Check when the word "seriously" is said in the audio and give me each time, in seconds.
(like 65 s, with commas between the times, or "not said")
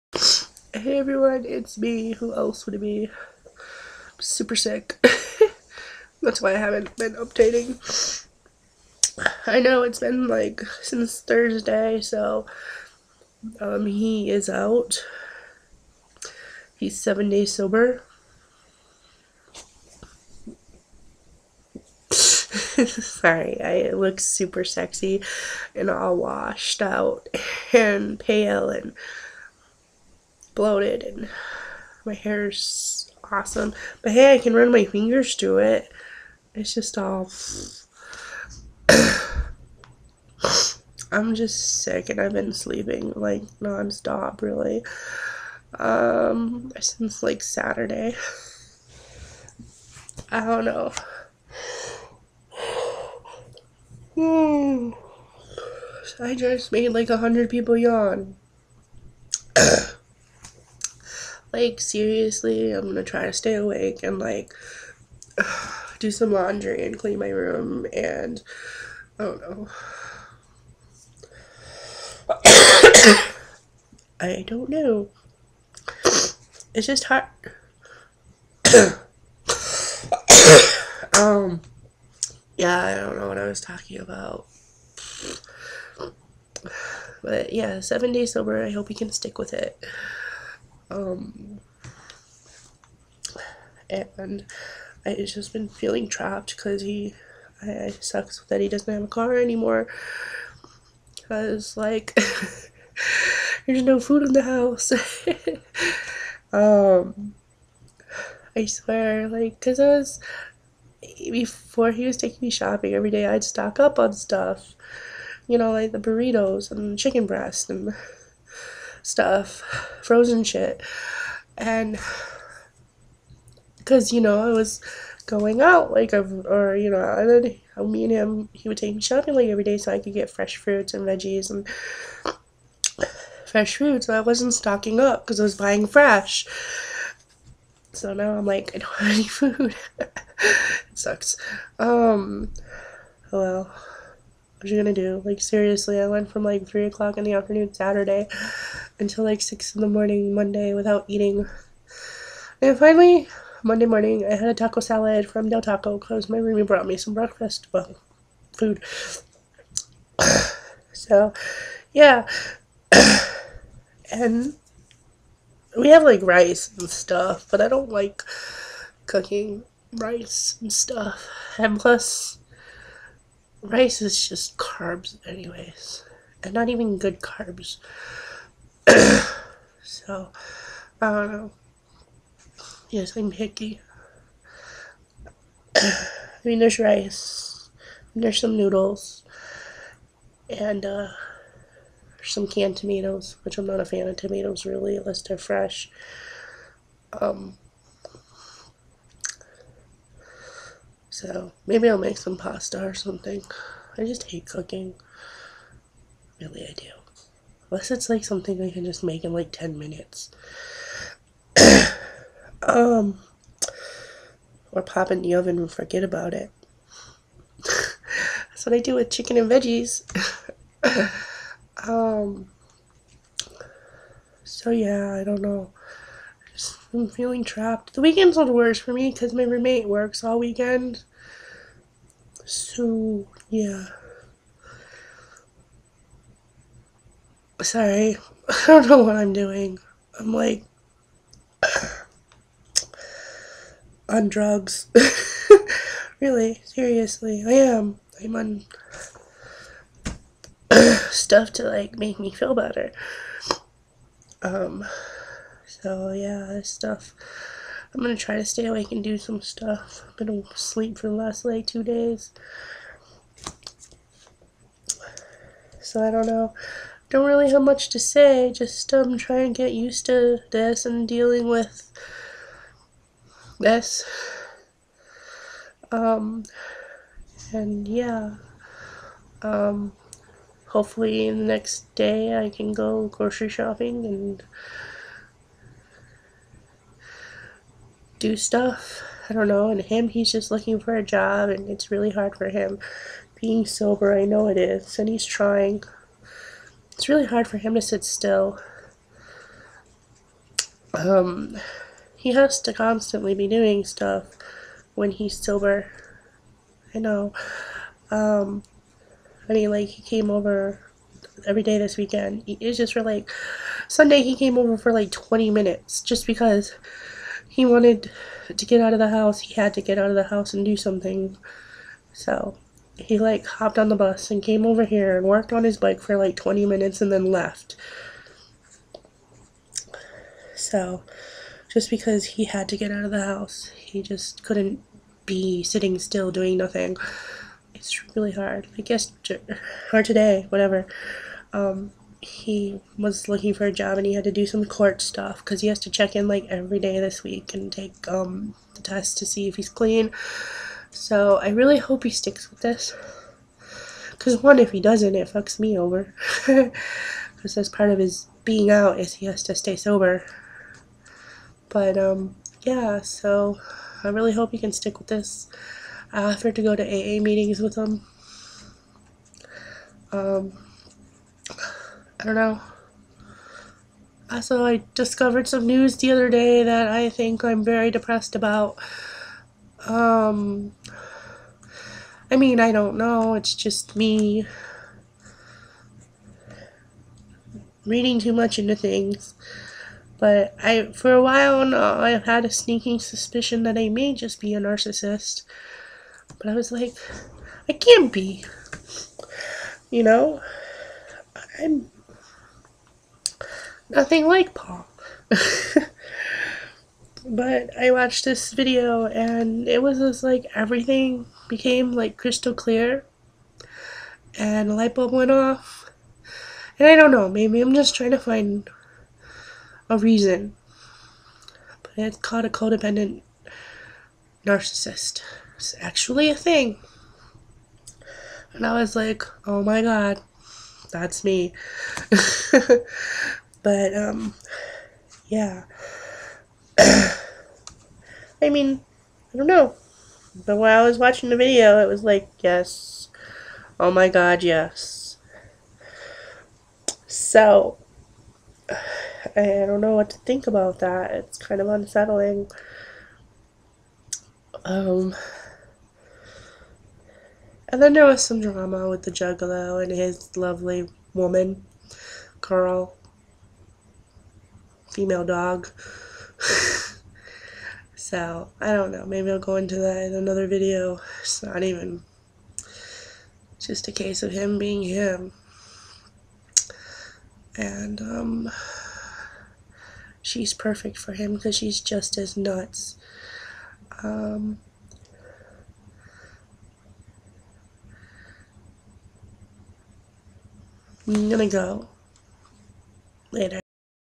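61 s, 145 s, 246 s.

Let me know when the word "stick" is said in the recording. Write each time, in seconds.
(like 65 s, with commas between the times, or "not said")
89 s, 352 s, 364 s.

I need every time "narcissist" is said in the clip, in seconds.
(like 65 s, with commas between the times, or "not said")
394 s, 424 s.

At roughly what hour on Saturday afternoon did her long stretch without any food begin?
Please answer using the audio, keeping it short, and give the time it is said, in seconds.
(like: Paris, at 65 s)
3 o'clock, at 146 s.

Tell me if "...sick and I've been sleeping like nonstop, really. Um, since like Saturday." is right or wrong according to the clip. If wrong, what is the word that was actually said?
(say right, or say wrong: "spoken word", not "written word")
right.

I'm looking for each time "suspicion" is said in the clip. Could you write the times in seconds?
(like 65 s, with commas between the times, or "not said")
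392 s.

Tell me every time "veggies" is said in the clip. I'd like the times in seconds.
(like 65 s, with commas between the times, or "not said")
131 s, 219 s.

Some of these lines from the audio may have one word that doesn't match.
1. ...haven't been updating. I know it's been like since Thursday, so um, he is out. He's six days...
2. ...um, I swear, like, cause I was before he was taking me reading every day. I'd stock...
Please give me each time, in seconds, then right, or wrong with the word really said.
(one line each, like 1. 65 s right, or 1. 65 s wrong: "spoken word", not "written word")
1. 6 s wrong: "seven", not "six"
2. 106 s wrong: "shopping", not "reading".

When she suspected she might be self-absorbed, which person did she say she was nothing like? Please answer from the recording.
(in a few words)
Paul.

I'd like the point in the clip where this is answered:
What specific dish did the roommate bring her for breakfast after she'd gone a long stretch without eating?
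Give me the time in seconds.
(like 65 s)
154 s.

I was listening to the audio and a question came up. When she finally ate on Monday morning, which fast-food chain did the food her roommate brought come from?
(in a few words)
Del Taco.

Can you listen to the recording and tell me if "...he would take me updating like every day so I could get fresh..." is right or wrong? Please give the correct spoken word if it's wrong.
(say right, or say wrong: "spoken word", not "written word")
wrong: "shopping", not "updating".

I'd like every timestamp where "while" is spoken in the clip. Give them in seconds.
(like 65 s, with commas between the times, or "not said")
391 s, 440 s.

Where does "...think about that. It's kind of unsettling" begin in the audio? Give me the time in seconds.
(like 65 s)
450 s.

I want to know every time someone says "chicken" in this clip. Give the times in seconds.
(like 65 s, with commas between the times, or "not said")
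116 s, 219 s.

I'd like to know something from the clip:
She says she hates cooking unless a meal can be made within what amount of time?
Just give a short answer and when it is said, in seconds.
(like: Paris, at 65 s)
10 minutes, at 209 s.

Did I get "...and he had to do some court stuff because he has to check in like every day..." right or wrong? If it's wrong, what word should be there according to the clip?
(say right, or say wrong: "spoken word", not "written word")
right.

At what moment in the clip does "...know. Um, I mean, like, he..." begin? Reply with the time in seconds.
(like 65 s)
306 s.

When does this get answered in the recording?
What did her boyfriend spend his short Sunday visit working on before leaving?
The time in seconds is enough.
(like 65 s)
325 s.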